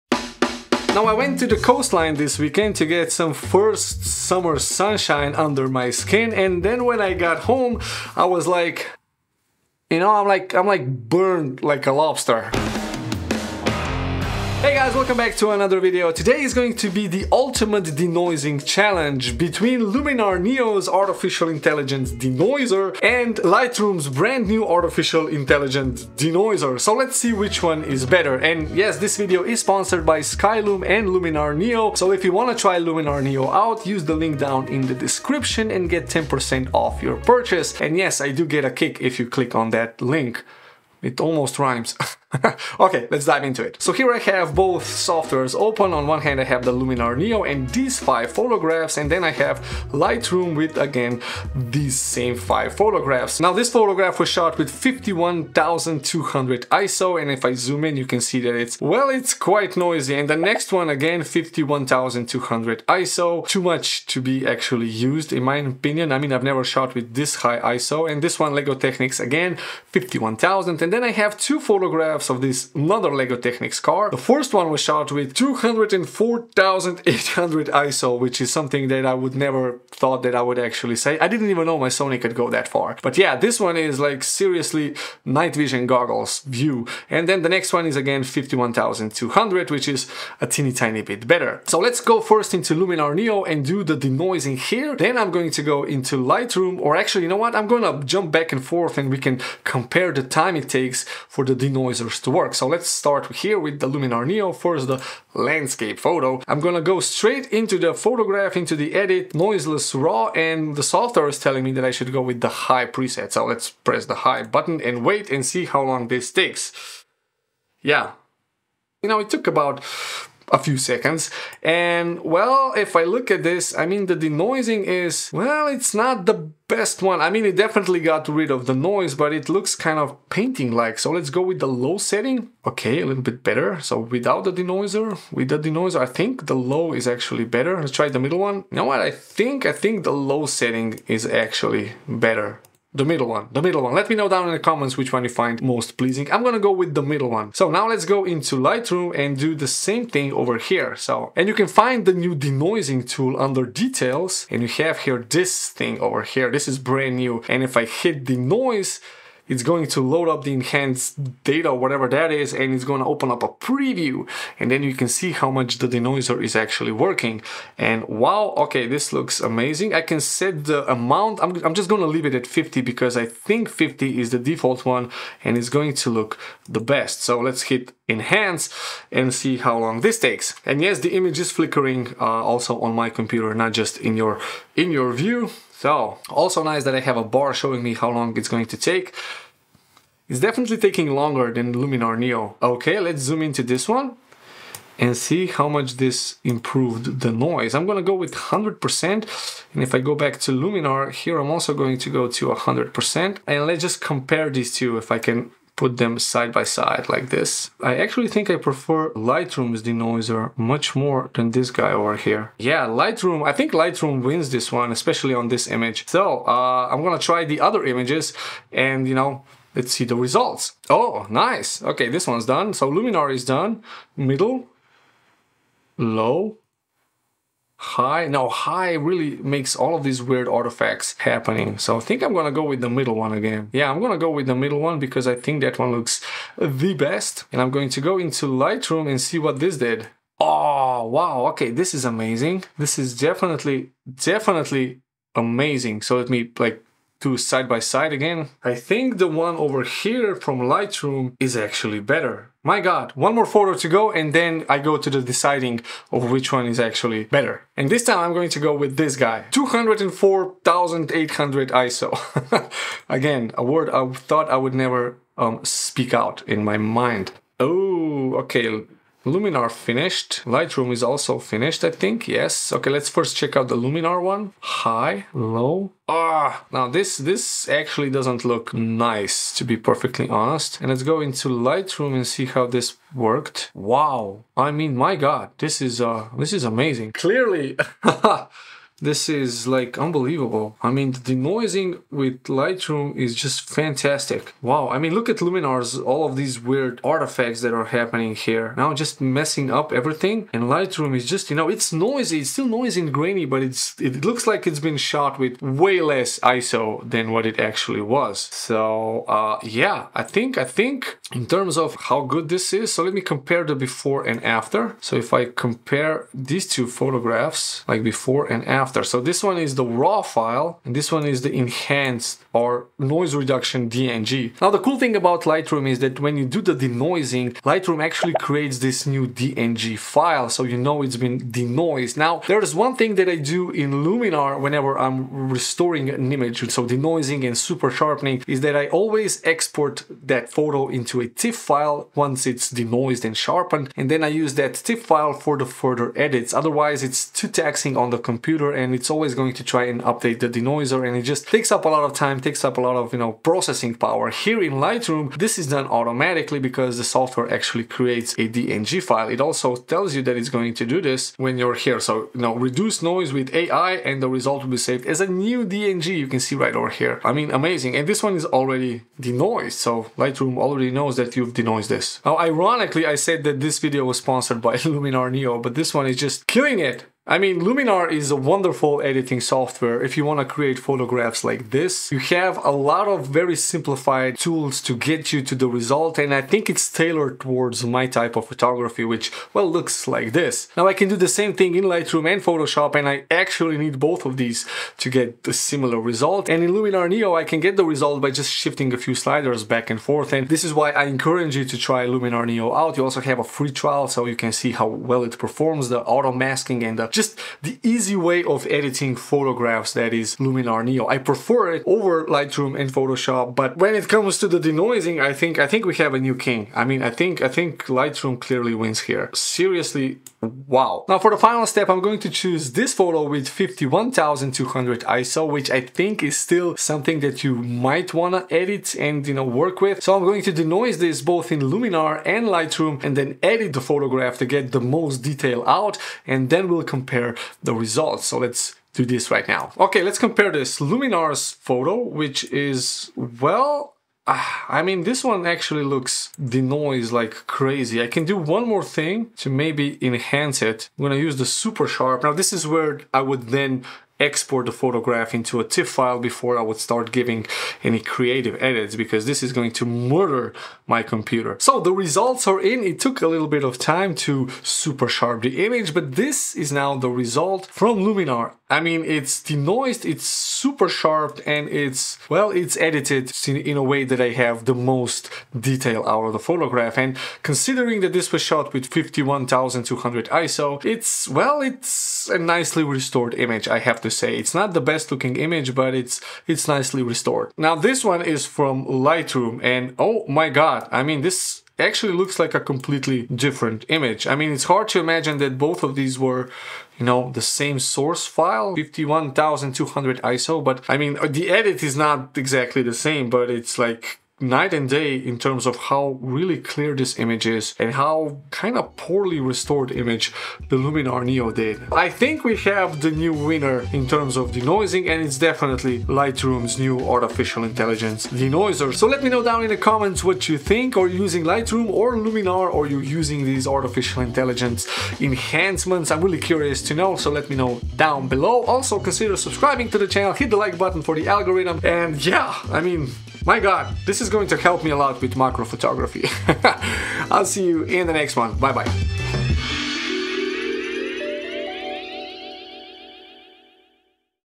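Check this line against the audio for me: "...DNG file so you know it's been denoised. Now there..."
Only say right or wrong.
right.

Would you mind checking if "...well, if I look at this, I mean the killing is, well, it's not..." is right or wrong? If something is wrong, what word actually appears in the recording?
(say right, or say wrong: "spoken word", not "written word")
wrong: "denoising", not "killing".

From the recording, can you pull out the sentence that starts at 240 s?
Oh, wow, okay, this is amazing.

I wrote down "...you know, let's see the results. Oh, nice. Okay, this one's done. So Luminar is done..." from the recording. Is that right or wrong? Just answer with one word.
right.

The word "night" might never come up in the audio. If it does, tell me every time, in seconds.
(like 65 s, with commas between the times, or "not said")
85 s, 504 s.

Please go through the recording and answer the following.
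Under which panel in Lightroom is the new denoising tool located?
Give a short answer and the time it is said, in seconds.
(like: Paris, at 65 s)
Details, at 153 s.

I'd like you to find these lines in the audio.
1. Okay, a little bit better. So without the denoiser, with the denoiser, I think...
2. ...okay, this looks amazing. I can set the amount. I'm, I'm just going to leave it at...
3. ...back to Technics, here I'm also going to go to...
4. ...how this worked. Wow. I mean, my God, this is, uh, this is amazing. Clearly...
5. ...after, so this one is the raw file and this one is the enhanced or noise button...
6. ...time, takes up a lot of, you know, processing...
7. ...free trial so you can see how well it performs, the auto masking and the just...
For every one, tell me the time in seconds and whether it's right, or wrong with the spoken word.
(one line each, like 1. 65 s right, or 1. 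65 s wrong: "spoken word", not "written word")
1. 132 s right
2. 168 s right
3. 200 s wrong: "Luminar", not "Technics"
4. 282 s right
5. 318 s wrong: "reduction", not "button"
6. 352 s right
7. 403 s right.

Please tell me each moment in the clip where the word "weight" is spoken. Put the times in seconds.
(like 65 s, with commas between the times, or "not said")
not said.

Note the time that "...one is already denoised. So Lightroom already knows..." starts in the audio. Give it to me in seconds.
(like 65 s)
368 s.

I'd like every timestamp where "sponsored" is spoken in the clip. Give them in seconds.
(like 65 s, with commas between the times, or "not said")
29 s, 374 s.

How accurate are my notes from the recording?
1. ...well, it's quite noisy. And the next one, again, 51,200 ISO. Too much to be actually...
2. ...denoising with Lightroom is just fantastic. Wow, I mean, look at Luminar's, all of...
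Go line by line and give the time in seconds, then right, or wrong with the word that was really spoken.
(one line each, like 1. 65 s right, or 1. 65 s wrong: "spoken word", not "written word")
1. 58 s right
2. 291 s right.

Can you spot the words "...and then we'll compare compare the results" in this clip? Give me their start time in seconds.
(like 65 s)
436 s.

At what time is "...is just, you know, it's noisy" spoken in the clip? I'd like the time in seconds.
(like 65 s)
301 s.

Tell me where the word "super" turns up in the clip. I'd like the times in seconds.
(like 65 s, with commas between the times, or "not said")
337 s, 451 s, 464 s, 470 s.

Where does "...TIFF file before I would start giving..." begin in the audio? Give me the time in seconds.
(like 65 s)
455 s.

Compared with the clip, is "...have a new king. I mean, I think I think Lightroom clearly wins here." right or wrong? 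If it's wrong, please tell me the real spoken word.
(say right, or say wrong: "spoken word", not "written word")
right.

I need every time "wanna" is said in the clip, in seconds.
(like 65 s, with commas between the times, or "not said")
428 s.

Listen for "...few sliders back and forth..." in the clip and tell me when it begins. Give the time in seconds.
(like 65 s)
398 s.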